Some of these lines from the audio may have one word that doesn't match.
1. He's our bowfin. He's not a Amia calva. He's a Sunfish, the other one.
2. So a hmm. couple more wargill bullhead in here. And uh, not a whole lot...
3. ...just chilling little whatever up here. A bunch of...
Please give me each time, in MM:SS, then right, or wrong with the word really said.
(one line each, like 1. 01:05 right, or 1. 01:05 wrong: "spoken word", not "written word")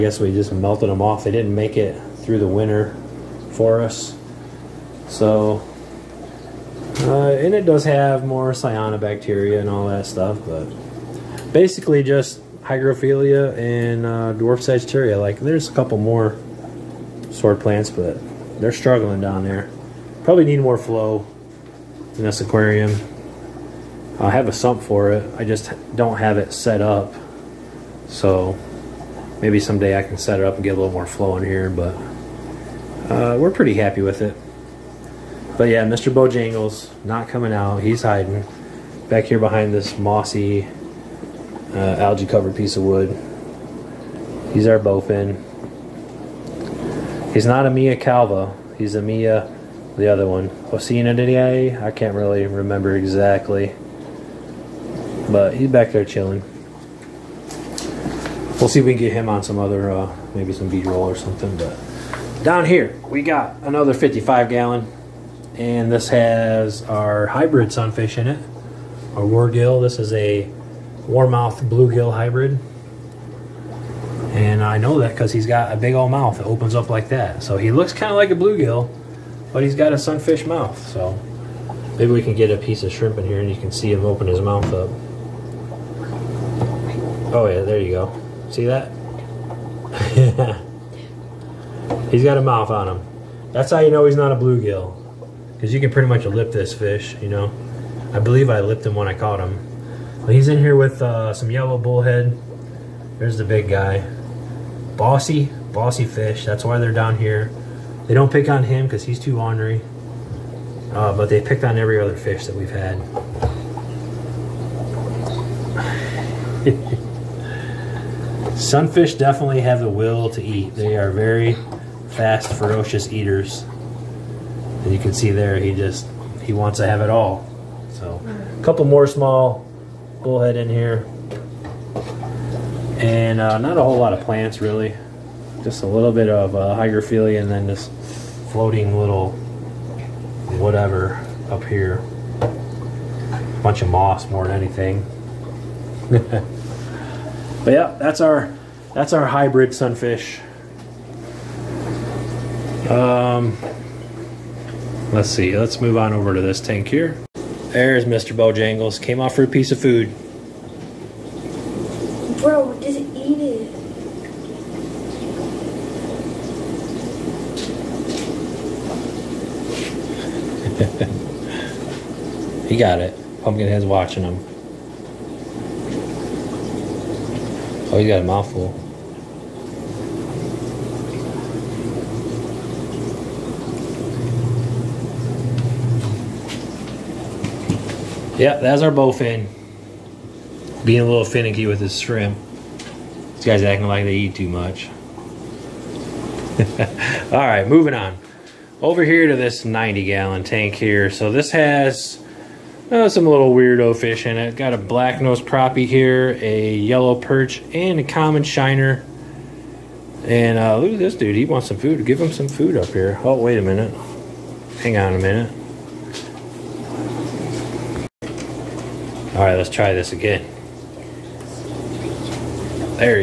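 1. 00:44 wrong: "Mia", not "Sunfish"
2. 02:07 wrong: "small", not "wargill"
3. 02:17 wrong: "floating", not "chilling".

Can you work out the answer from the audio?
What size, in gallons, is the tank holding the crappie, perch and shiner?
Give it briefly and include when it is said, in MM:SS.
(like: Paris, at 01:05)
90, at 03:19.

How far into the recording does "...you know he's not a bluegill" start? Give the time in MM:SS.
01:33.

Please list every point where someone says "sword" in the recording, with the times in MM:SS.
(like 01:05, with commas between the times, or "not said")
00:17.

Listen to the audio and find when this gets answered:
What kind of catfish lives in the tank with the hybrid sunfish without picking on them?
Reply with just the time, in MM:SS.
01:41.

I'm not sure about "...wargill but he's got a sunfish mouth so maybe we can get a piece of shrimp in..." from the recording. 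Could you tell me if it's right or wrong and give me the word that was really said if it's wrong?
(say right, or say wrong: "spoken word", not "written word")
wrong: "bluegill", not "wargill".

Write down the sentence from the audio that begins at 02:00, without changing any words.
They are very fast, ferocious eaters.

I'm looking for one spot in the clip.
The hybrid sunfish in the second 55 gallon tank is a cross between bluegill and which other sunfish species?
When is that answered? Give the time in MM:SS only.
01:11.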